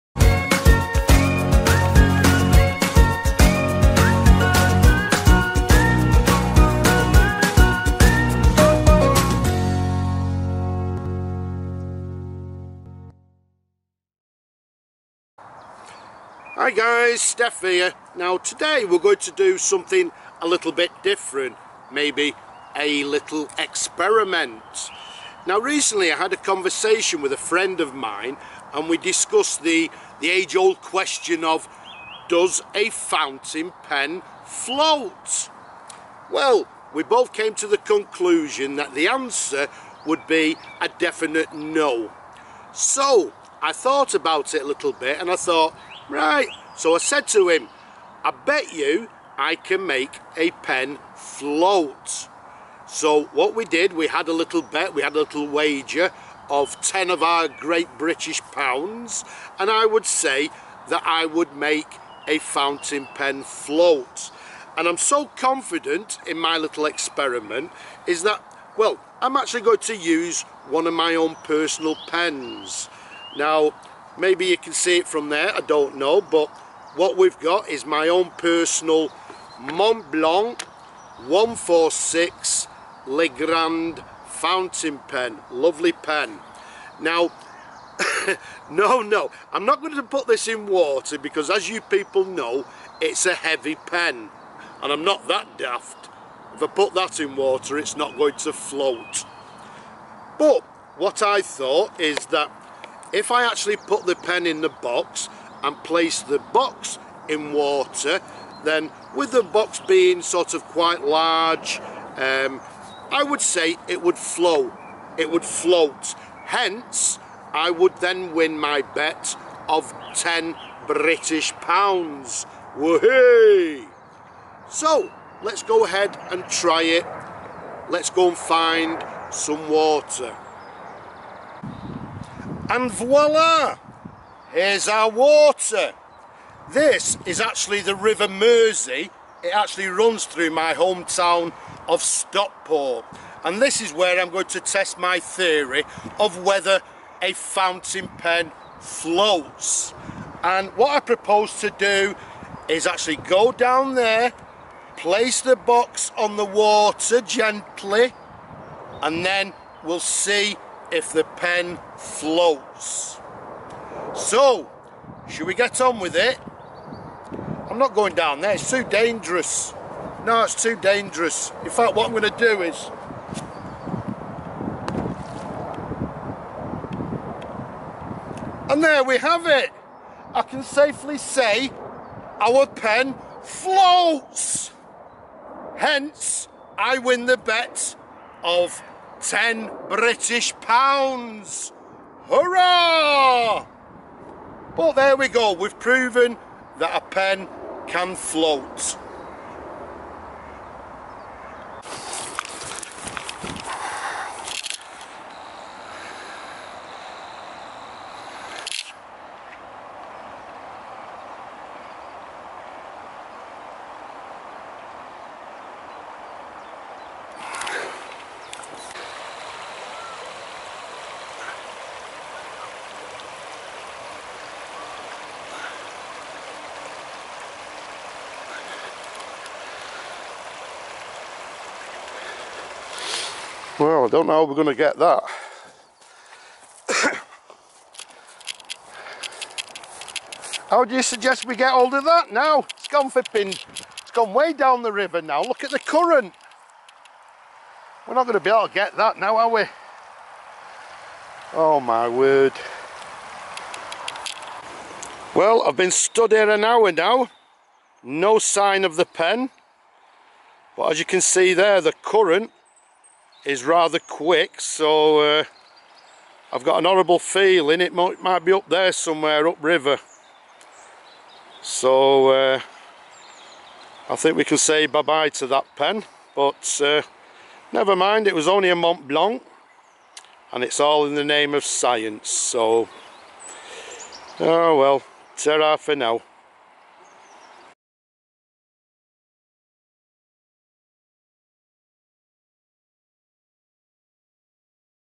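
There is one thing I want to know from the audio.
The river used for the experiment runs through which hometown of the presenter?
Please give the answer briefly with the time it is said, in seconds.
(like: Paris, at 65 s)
Stockport, at 142 s.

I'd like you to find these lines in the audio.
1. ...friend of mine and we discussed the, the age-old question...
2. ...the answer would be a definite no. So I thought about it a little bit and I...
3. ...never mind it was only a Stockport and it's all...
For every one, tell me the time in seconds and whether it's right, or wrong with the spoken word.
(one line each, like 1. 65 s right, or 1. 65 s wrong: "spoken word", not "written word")
1. 27 s right
2. 38 s right
3. 277 s wrong: "Montblanc", not "Stockport".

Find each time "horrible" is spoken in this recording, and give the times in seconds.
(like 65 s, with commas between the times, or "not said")
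266 s.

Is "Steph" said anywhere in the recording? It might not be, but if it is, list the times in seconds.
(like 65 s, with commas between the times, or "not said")
17 s.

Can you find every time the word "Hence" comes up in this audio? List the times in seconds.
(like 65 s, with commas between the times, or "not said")
116 s, 185 s.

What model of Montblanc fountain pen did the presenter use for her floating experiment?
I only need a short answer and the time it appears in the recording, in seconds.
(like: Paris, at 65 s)
146 Le Grand, at 81 s.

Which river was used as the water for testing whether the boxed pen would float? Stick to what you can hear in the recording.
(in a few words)
River Mersey.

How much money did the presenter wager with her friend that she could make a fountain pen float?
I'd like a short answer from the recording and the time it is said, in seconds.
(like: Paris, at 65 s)
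10 British pounds, at 56 s.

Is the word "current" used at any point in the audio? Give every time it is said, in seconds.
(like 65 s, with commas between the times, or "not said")
245 s, 262 s.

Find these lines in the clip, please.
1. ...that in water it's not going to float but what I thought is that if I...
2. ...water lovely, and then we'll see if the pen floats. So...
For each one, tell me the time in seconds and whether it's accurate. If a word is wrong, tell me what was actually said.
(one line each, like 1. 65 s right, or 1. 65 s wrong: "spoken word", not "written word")
1. 96 s right
2. 156 s wrong: "gently", not "lovely".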